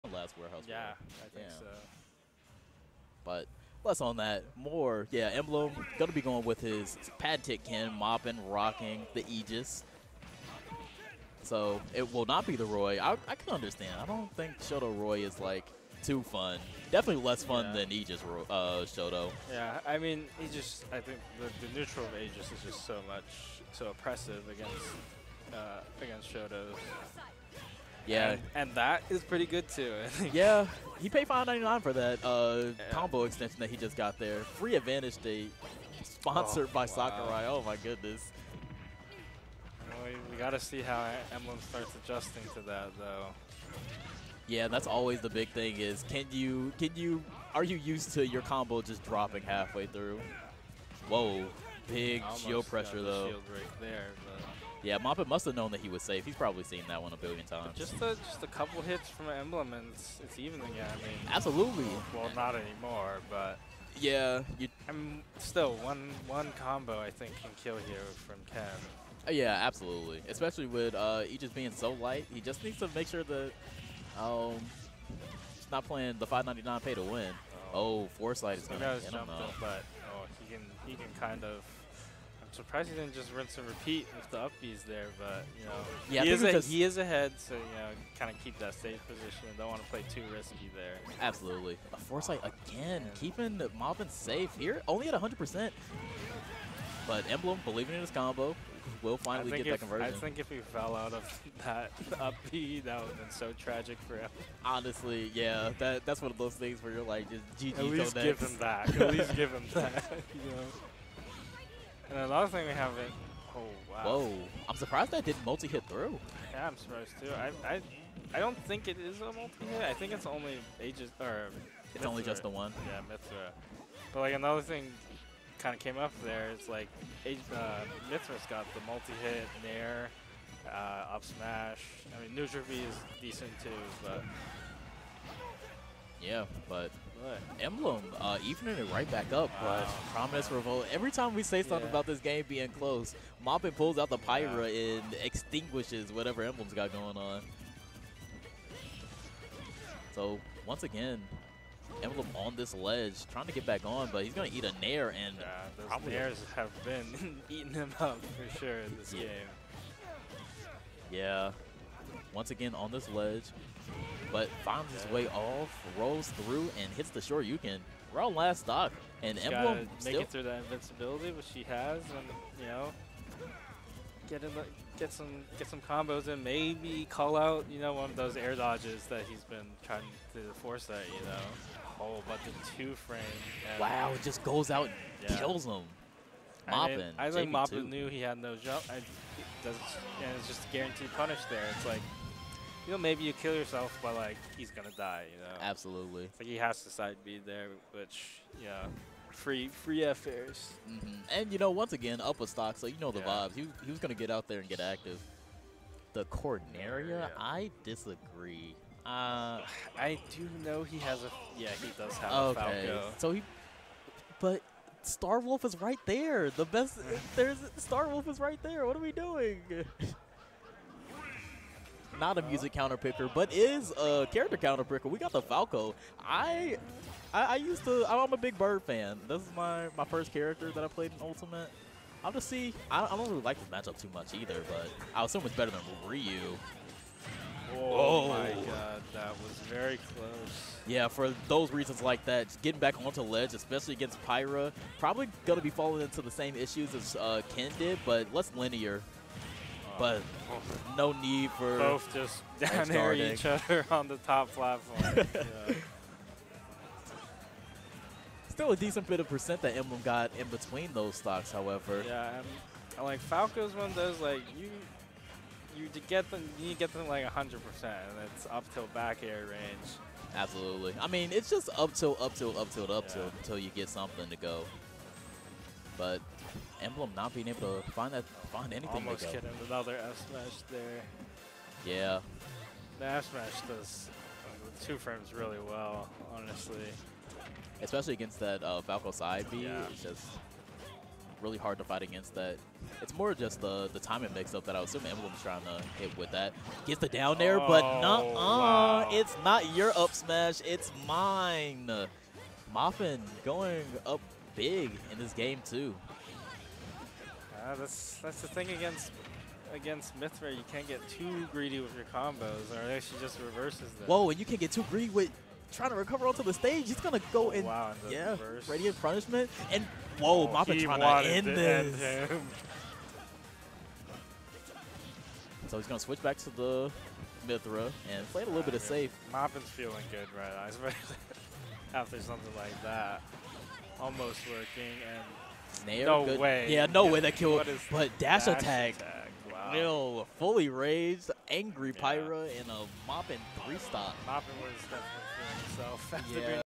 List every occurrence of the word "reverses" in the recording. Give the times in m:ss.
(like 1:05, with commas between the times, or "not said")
5:13, 5:18.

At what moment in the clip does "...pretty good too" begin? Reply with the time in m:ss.
0:29.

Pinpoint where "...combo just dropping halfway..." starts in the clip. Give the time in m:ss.
0:48.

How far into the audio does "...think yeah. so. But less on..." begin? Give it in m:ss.
0:01.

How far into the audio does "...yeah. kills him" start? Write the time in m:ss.
3:05.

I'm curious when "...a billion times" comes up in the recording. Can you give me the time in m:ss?
0:57.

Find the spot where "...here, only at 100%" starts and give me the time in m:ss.
1:34.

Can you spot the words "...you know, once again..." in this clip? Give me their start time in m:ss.
3:21.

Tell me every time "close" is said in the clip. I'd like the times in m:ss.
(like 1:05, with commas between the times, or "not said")
2:22, 4:00.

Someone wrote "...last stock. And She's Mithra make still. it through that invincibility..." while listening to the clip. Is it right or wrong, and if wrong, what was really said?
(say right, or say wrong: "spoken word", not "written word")
wrong: "Emblem", not "Mithra".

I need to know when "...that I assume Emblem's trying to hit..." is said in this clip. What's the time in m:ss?
4:54.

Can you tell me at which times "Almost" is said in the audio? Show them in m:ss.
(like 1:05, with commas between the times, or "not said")
4:39, 5:33.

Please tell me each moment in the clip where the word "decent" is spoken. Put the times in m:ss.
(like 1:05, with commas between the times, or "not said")
2:13, 4:18.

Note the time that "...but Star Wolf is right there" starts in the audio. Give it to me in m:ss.
3:34.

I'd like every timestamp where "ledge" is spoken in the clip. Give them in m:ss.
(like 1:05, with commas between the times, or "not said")
2:32, 2:43, 4:03.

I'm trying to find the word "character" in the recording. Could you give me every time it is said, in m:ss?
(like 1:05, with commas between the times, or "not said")
3:44, 3:50.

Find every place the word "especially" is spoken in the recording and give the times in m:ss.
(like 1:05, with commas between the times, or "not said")
1:10, 4:03, 4:47.